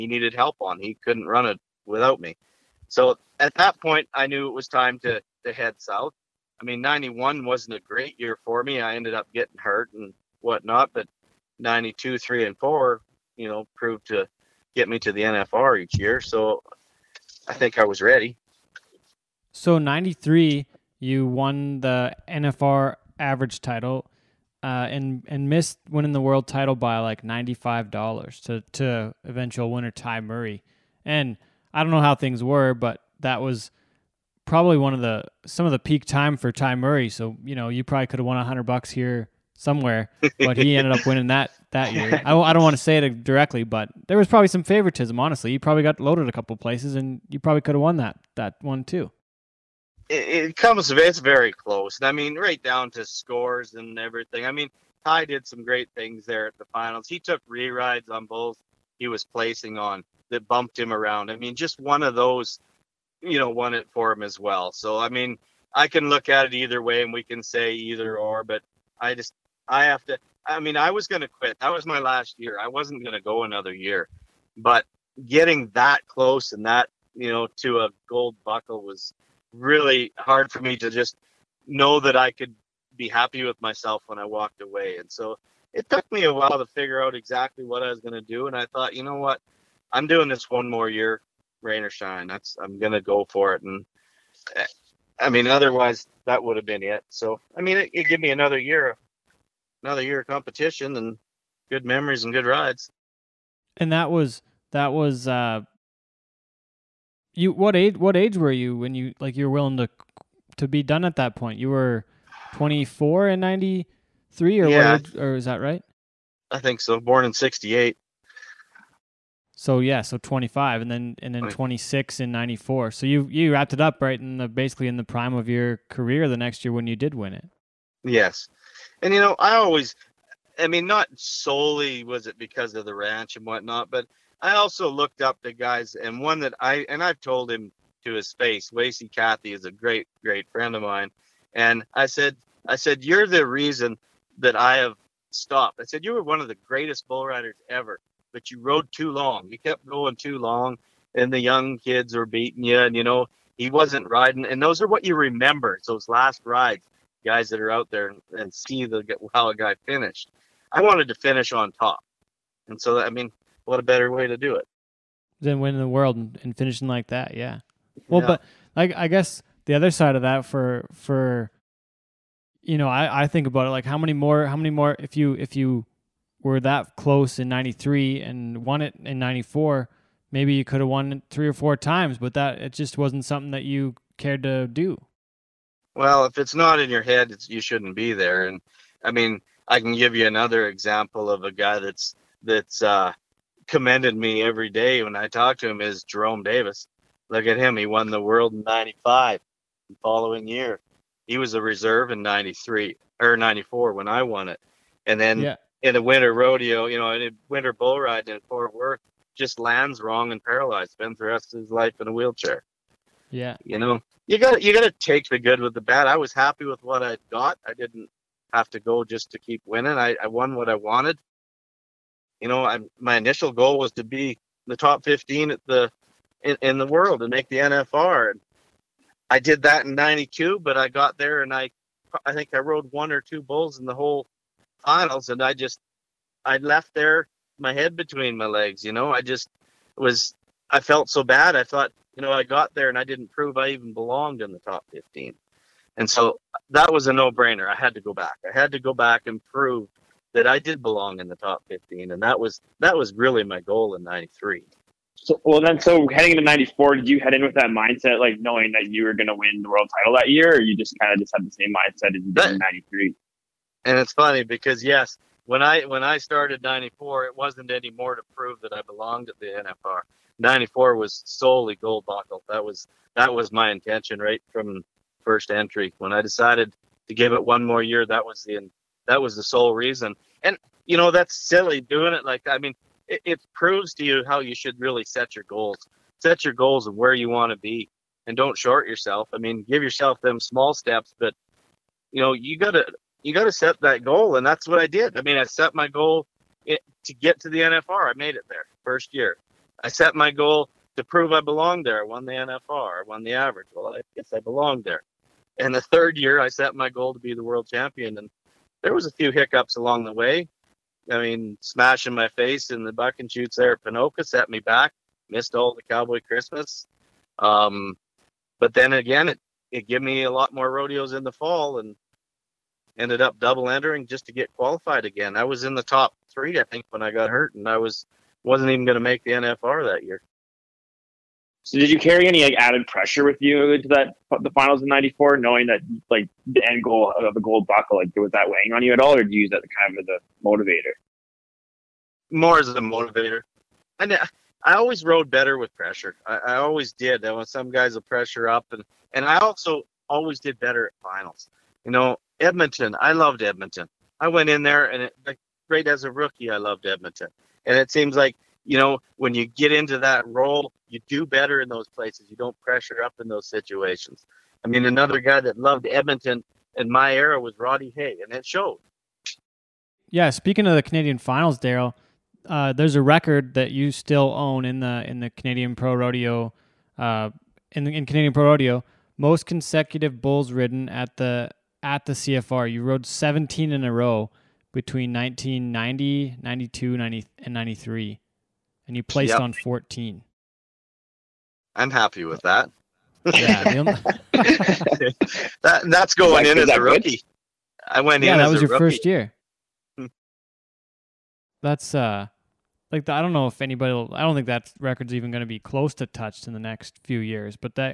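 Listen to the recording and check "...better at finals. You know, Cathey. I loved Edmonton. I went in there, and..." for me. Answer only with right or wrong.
wrong.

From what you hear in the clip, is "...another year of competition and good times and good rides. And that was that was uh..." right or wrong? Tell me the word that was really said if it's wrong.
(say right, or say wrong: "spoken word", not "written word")
wrong: "memories", not "times".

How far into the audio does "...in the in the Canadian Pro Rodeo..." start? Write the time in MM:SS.
06:14.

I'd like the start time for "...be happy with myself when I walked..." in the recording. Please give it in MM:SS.
01:22.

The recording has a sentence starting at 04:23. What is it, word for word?
And it's funny because yes, when I when I started '94, it wasn't anymore to prove that I belonged at the NFR.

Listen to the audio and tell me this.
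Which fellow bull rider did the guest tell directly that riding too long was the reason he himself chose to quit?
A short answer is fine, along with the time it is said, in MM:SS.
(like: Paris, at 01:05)
Wacey Cathey, at 02:18.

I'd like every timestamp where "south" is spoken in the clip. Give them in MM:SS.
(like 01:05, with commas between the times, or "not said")
00:05.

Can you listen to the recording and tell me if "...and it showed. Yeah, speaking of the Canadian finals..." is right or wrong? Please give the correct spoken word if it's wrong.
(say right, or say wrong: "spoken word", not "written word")
right.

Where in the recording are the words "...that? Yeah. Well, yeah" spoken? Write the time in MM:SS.
02:47.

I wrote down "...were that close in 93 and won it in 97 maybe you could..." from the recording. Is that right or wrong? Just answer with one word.
wrong.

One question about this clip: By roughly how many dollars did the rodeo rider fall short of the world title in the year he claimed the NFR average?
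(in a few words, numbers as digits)
95.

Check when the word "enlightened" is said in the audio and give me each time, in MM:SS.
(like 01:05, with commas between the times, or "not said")
not said.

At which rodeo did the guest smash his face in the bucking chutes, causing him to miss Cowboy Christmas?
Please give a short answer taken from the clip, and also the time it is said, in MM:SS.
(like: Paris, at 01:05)
Ponoka, at 05:13.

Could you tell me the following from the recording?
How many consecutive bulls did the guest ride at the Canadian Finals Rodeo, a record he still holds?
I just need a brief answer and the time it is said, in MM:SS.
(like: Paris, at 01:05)
17, at 06:23.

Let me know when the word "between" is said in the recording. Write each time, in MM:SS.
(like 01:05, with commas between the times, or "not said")
03:57, 06:24.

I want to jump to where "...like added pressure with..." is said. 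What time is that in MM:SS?
05:32.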